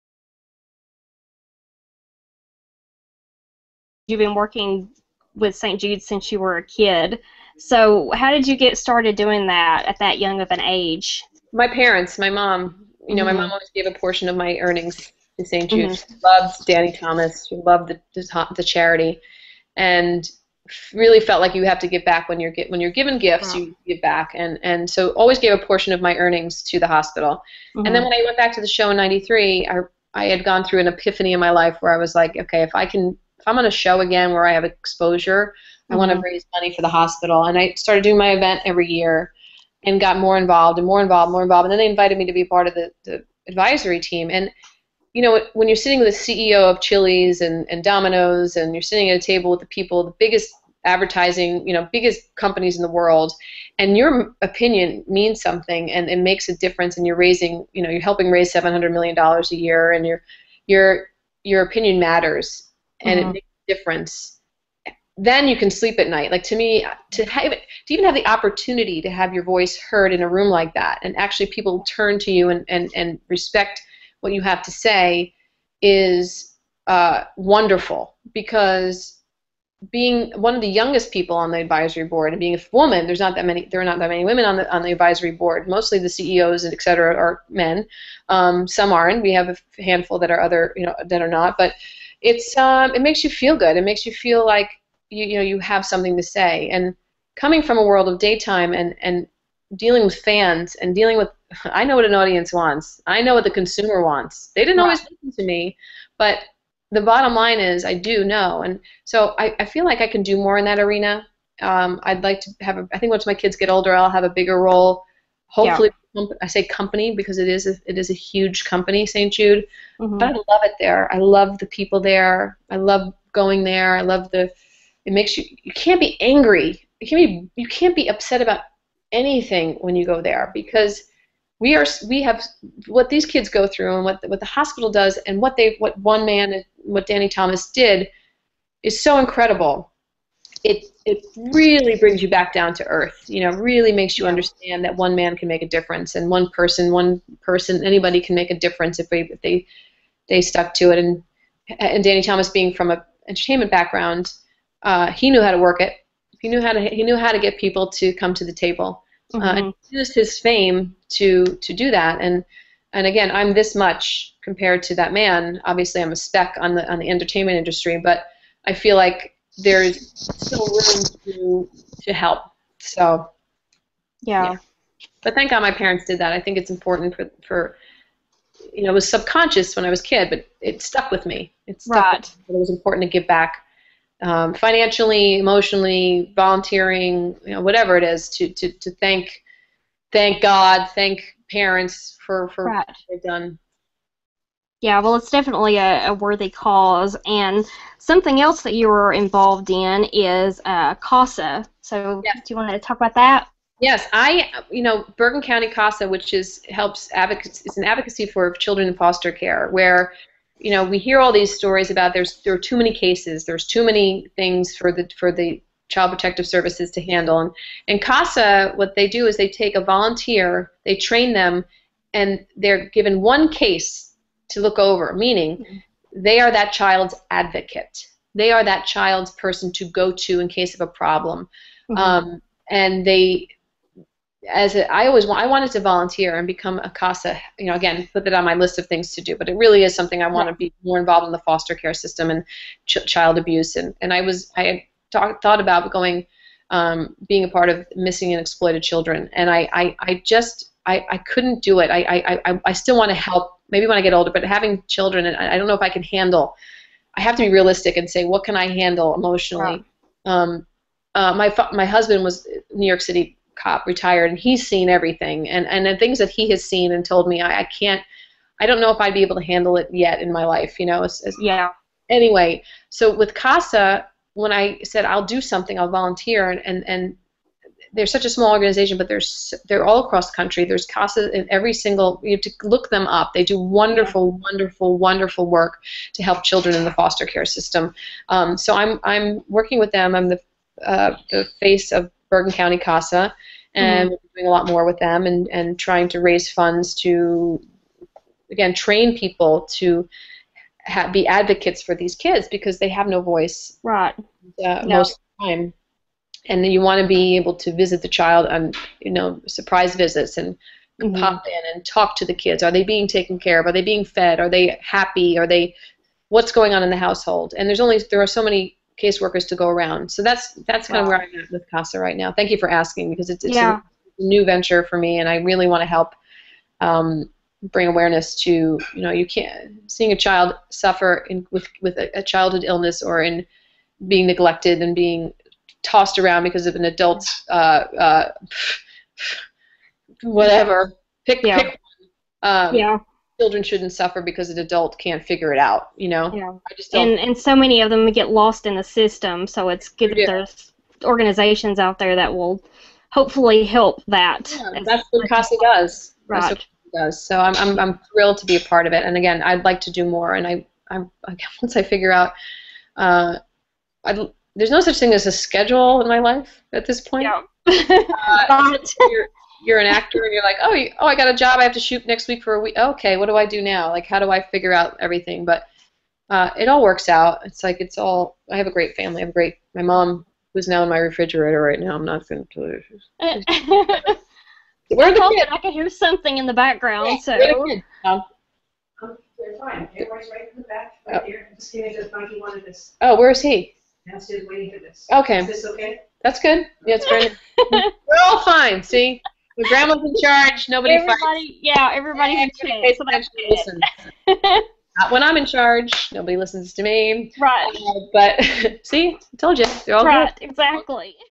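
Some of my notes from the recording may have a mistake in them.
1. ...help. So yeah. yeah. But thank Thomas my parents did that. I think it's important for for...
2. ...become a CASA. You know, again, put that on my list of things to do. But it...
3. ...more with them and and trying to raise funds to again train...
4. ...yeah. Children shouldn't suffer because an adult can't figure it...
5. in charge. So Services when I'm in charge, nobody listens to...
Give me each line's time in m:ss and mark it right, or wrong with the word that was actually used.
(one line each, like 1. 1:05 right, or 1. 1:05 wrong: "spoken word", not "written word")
1. 2:52 wrong: "God", not "Thomas"
2. 3:56 right
3. 4:54 right
4. 5:42 right
5. 6:42 wrong: "Not", not "Services".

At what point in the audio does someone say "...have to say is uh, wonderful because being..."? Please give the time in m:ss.
1:14.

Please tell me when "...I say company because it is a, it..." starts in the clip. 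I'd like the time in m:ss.
1:56.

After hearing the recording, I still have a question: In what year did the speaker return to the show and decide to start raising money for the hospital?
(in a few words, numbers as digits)
1993.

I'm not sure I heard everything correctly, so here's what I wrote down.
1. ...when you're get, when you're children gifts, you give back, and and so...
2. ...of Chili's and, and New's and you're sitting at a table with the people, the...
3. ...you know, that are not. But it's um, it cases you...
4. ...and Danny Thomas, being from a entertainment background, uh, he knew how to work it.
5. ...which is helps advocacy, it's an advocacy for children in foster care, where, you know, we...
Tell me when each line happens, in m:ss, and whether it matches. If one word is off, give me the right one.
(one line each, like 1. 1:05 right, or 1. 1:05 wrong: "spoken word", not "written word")
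1. 0:22 wrong: "given", not "children"
2. 0:46 wrong: "Domino", not "New"
3. 1:30 wrong: "makes", not "cases"
4. 2:31 right
5. 3:26 right.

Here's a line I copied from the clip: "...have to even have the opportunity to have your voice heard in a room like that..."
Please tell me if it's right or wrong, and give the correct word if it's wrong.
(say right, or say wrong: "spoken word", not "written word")
right.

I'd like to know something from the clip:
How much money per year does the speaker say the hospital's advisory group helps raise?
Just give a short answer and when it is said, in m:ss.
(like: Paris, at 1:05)
$700 million, at 0:58.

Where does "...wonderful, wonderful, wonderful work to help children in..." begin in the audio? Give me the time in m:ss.
4:43.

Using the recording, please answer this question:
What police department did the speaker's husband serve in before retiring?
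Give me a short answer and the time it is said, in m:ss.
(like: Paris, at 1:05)
New York City, at 4:22.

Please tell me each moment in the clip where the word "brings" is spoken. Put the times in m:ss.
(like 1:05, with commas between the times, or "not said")
2:21, 5:27.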